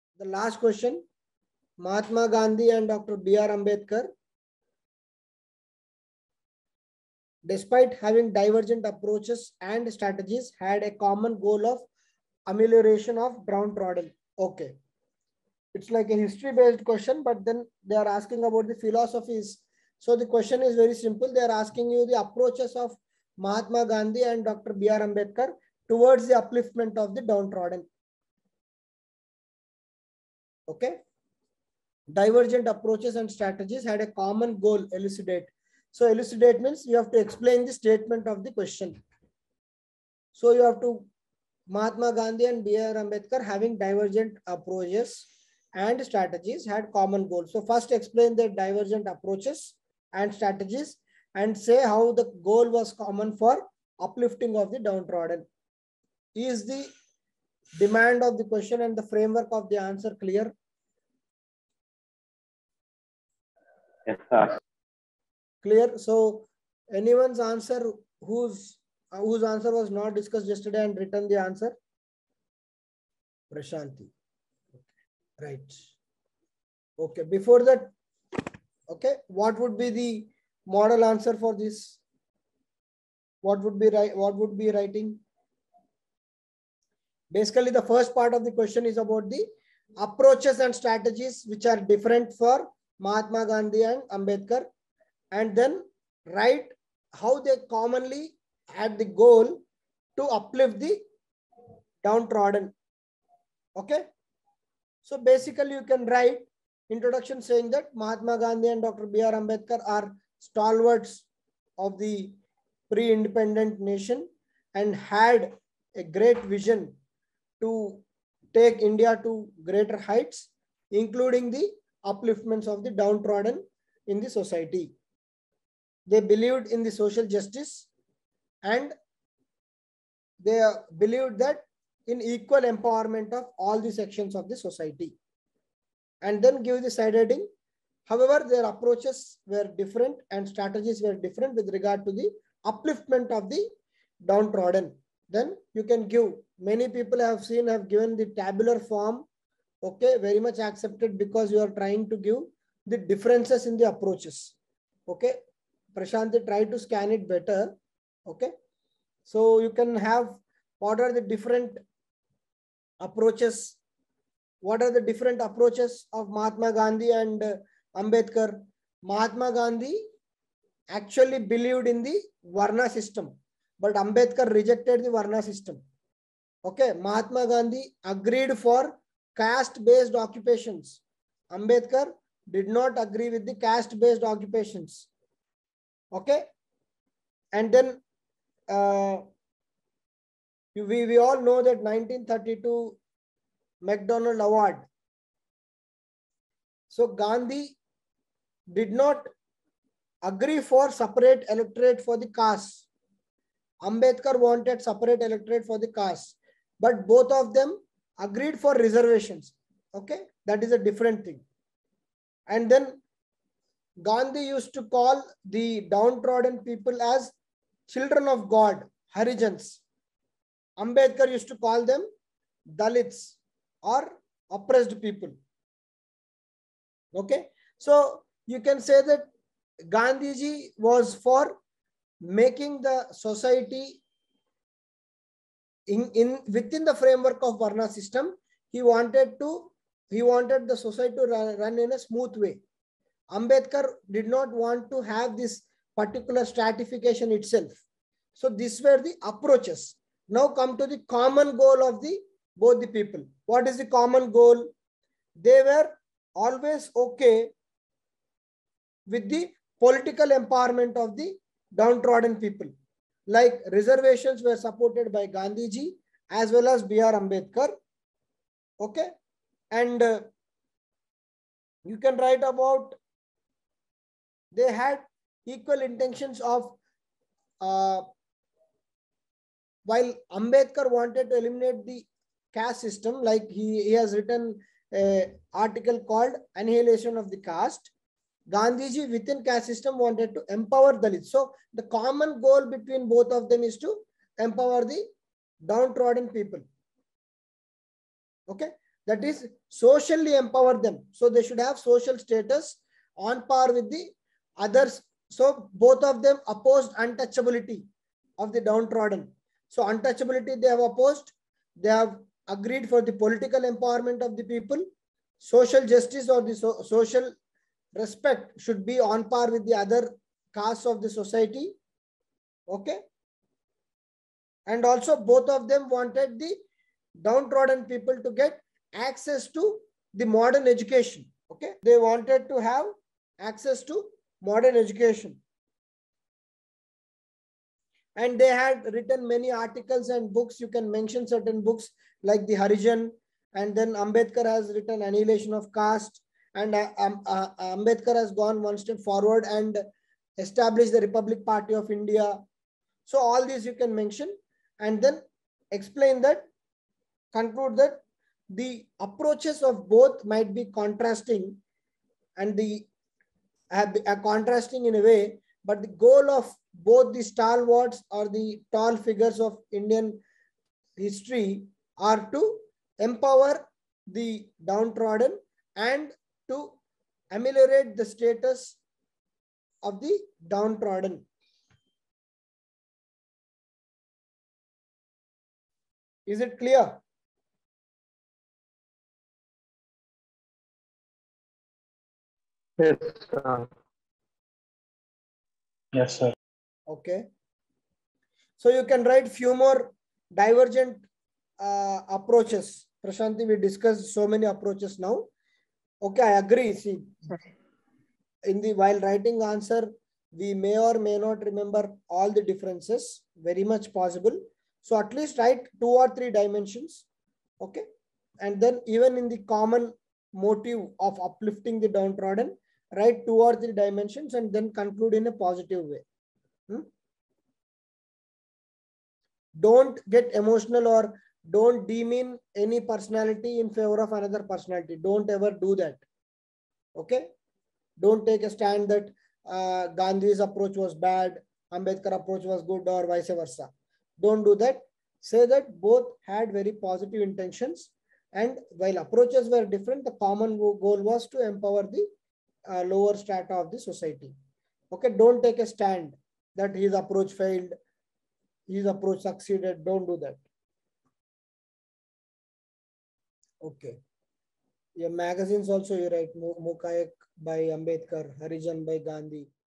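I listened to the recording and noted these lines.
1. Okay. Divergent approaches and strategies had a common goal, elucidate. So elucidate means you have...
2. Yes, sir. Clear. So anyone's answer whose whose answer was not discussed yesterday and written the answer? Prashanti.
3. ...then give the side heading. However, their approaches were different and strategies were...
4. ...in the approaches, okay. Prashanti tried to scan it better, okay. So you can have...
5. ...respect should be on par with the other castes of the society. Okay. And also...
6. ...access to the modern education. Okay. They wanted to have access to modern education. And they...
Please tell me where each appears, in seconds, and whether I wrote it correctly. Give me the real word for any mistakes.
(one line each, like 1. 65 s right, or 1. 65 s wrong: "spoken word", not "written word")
1. 30 s right
2. 64 s right
3. 136 s right
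4. 153 s right
5. 317 s right
6. 328 s right.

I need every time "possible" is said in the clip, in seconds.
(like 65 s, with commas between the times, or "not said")
413 s.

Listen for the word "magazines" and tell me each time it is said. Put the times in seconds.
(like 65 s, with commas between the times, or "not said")
465 s.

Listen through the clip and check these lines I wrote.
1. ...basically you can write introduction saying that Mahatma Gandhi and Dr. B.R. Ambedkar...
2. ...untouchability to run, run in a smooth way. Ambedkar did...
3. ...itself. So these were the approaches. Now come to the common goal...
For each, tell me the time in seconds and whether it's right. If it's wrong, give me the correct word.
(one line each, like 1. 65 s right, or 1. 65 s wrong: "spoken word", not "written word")
1. 105 s right
2. 240 s wrong: "society", not "untouchability"
3. 247 s right.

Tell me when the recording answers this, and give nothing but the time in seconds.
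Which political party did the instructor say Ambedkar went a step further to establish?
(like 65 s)
351 s.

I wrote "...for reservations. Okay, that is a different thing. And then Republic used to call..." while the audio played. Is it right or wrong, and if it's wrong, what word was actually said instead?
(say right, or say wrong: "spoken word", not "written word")
wrong: "Gandhi", not "Republic".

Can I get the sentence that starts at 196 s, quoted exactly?
So Gandhi did not agree for separate electorate for the caste.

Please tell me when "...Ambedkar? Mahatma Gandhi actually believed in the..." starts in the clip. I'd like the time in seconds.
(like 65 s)
167 s.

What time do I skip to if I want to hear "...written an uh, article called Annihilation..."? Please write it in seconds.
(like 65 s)
284 s.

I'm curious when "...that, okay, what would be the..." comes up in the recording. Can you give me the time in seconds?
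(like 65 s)
77 s.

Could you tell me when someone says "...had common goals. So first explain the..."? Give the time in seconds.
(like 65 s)
46 s.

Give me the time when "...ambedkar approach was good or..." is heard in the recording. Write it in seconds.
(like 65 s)
441 s.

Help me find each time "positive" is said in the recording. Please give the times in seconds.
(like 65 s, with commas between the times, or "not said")
425 s, 446 s.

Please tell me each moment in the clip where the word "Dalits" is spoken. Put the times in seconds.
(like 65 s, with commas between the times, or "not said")
222 s, 290 s.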